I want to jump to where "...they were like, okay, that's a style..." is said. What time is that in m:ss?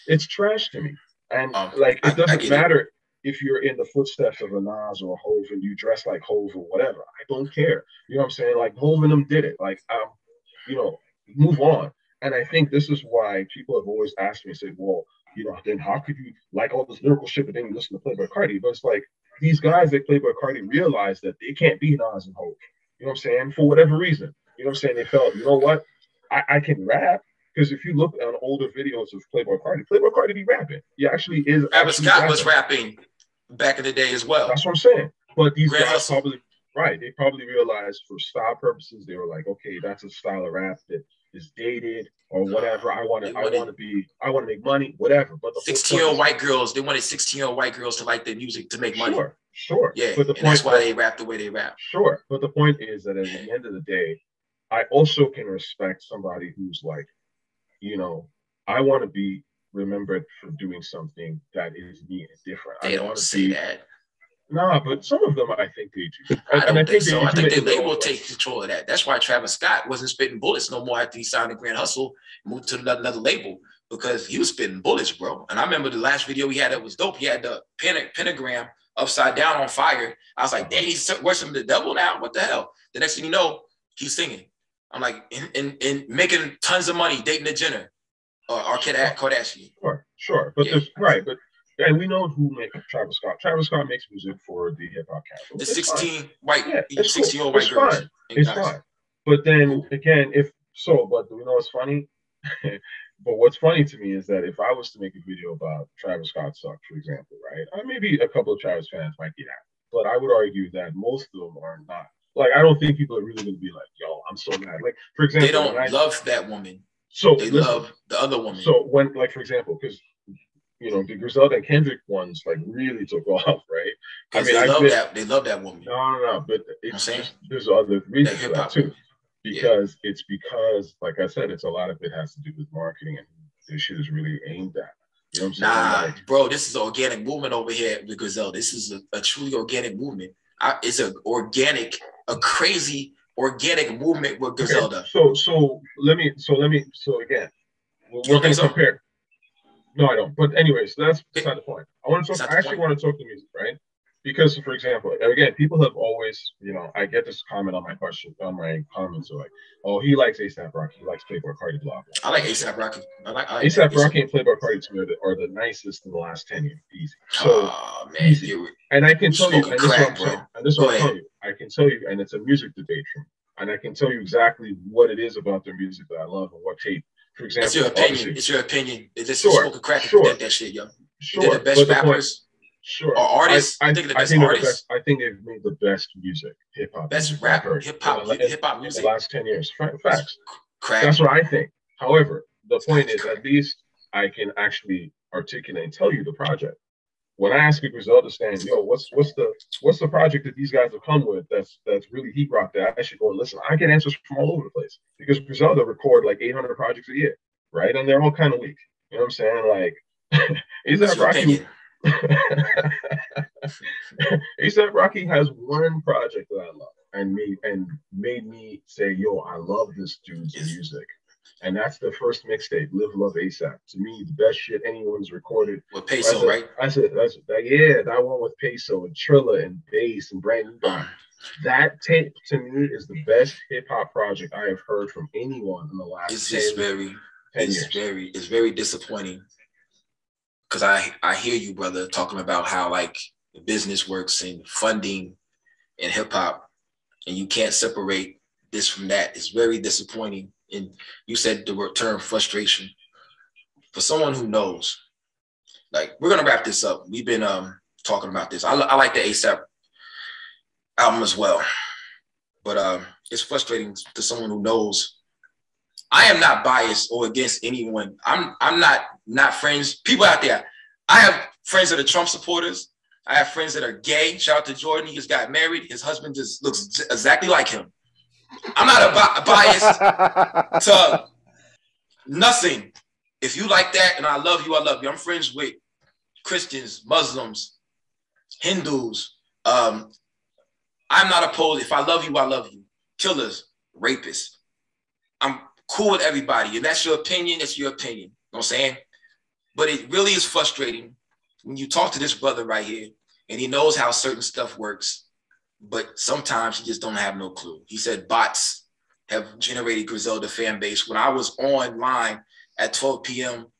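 0:39.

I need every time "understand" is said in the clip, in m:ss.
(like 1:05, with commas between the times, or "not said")
3:18.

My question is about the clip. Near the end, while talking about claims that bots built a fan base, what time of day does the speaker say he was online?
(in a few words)
12 p.m.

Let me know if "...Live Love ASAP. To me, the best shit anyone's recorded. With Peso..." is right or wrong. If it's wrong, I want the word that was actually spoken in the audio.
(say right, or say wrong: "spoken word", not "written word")
right.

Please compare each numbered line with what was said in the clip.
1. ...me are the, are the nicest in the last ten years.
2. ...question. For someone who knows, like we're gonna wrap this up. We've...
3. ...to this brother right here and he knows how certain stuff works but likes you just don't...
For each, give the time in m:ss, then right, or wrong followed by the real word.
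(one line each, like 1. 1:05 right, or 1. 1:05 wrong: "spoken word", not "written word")
1. 2:44 right
2. 4:12 wrong: "frustration", not "question"
3. 5:02 wrong: "sometimes", not "likes".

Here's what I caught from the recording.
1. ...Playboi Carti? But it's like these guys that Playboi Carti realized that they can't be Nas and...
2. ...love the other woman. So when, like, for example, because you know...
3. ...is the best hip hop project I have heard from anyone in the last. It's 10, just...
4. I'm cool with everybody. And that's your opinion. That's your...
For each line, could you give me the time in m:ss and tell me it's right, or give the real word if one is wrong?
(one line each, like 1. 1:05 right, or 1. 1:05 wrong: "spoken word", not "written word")
1. 0:18 right
2. 1:57 right
3. 3:52 right
4. 4:55 right.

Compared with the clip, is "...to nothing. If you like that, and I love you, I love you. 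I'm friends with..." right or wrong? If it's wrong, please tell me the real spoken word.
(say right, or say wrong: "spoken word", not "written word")
right.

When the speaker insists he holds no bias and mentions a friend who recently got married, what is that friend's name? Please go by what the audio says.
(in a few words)
Jordan.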